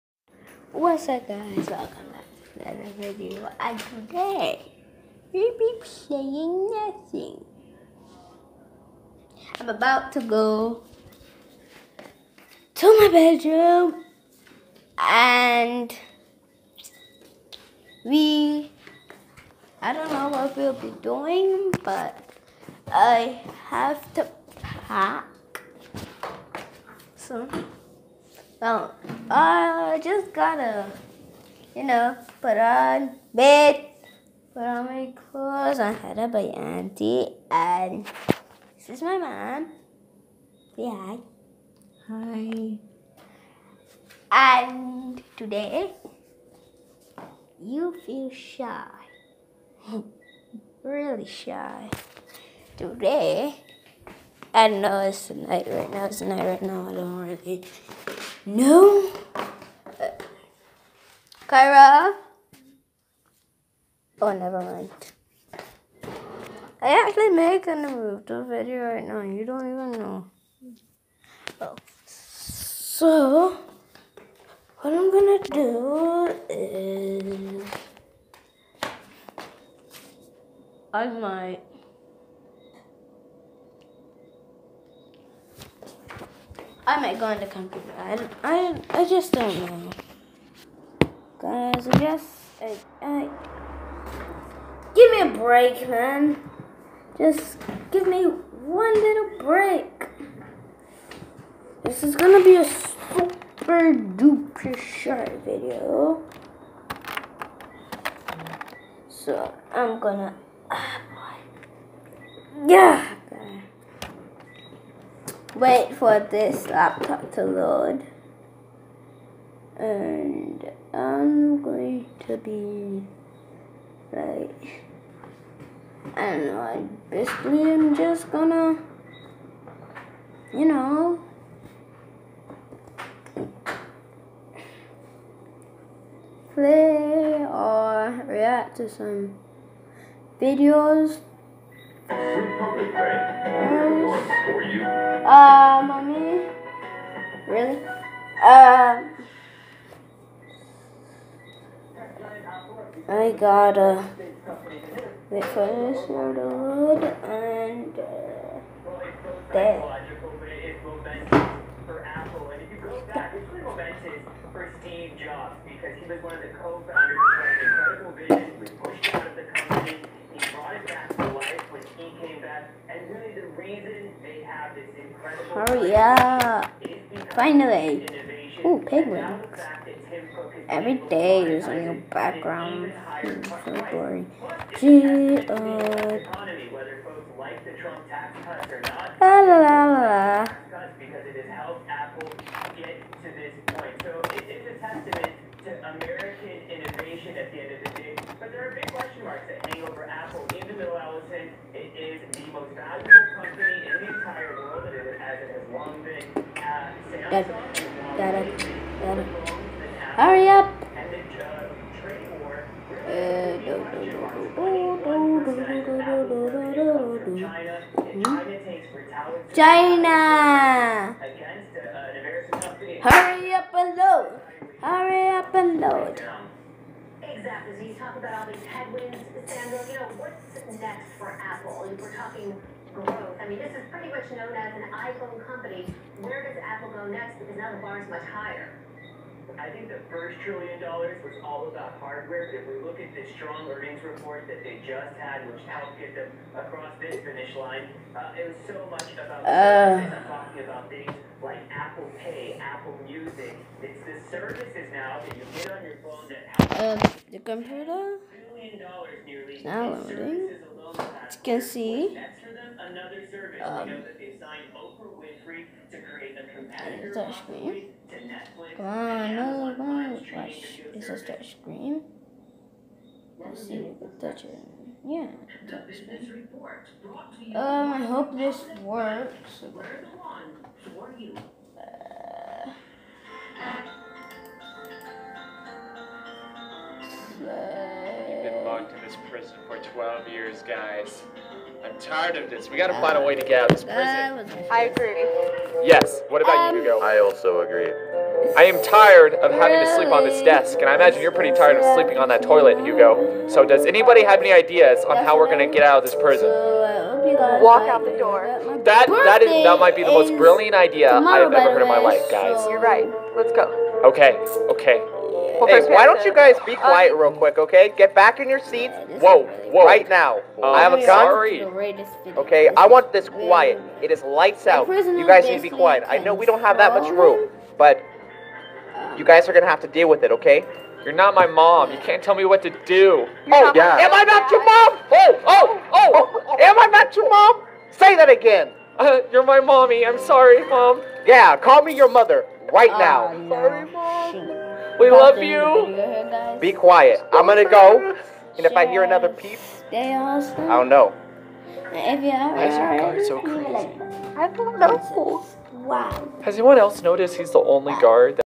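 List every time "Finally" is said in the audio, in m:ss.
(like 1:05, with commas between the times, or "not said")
2:57.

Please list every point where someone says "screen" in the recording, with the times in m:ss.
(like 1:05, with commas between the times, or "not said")
4:27, 4:31, 4:35.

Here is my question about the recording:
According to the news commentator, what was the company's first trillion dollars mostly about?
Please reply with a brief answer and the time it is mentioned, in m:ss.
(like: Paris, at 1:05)
Hardware, at 4:01.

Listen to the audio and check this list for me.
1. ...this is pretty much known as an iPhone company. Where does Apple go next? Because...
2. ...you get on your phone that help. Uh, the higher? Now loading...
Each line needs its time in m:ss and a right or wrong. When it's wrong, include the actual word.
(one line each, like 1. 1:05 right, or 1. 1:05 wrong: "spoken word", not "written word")
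1. 3:53 right
2. 4:15 wrong: "computer", not "higher".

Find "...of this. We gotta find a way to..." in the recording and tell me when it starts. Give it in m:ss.
4:52.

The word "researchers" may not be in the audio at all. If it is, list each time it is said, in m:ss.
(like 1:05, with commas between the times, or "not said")
not said.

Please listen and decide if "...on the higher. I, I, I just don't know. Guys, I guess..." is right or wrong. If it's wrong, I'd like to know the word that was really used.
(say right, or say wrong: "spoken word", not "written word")
wrong: "computer", not "higher".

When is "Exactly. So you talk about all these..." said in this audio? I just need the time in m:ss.
3:47.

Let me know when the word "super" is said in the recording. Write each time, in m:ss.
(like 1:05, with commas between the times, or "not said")
1:42.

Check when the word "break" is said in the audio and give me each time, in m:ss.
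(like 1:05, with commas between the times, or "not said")
1:35, 1:39.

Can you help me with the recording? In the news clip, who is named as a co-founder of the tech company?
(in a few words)
Steve Jobs.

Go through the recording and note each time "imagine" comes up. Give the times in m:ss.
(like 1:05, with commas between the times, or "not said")
5:00.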